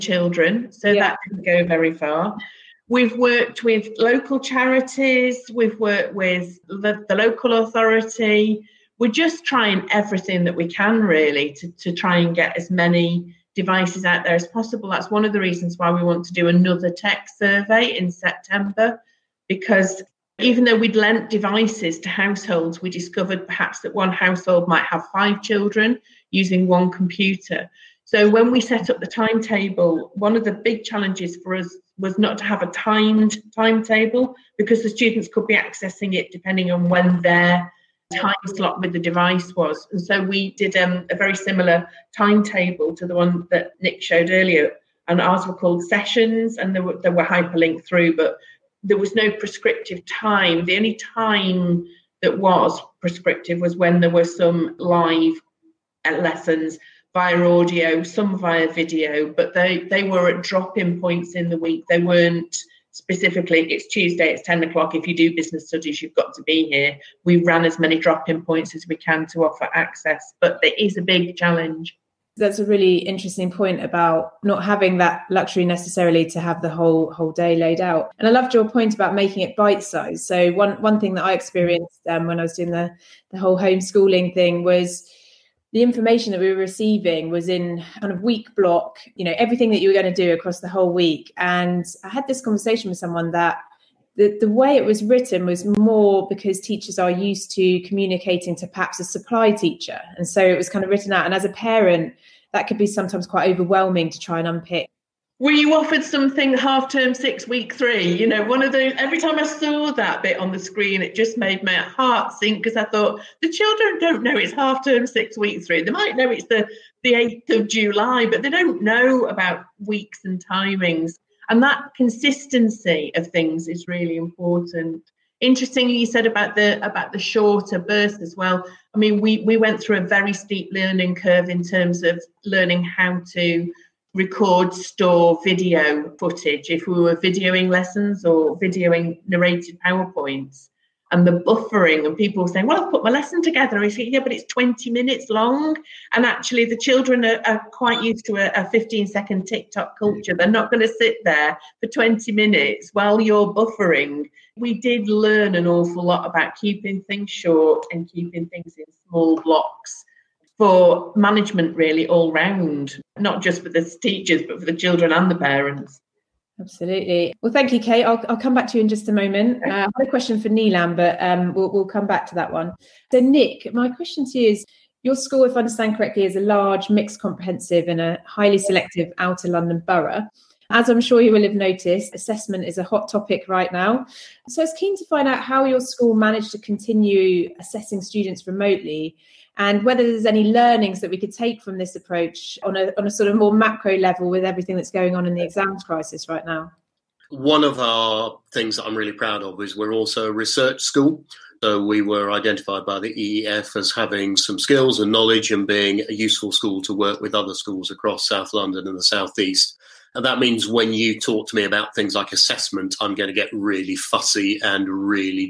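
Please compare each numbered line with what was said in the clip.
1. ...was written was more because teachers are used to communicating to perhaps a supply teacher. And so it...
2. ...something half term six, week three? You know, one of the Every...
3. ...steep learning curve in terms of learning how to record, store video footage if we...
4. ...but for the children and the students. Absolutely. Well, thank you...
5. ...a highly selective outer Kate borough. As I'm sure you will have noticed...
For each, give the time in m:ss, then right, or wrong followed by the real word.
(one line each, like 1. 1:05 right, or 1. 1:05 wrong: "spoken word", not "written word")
1. 1:34 right
2. 1:46 right
3. 2:10 right
4. 2:44 wrong: "parents", not "students"
5. 2:58 wrong: "London", not "Kate".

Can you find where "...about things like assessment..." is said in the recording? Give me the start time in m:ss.
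3:31.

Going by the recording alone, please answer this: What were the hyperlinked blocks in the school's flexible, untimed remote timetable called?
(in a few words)
sessions.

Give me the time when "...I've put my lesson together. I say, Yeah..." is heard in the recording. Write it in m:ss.
2:22.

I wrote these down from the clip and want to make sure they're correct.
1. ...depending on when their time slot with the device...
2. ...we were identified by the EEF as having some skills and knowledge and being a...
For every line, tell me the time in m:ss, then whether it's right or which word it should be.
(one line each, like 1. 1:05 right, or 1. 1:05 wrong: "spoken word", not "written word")
1. 0:36 right
2. 3:21 right.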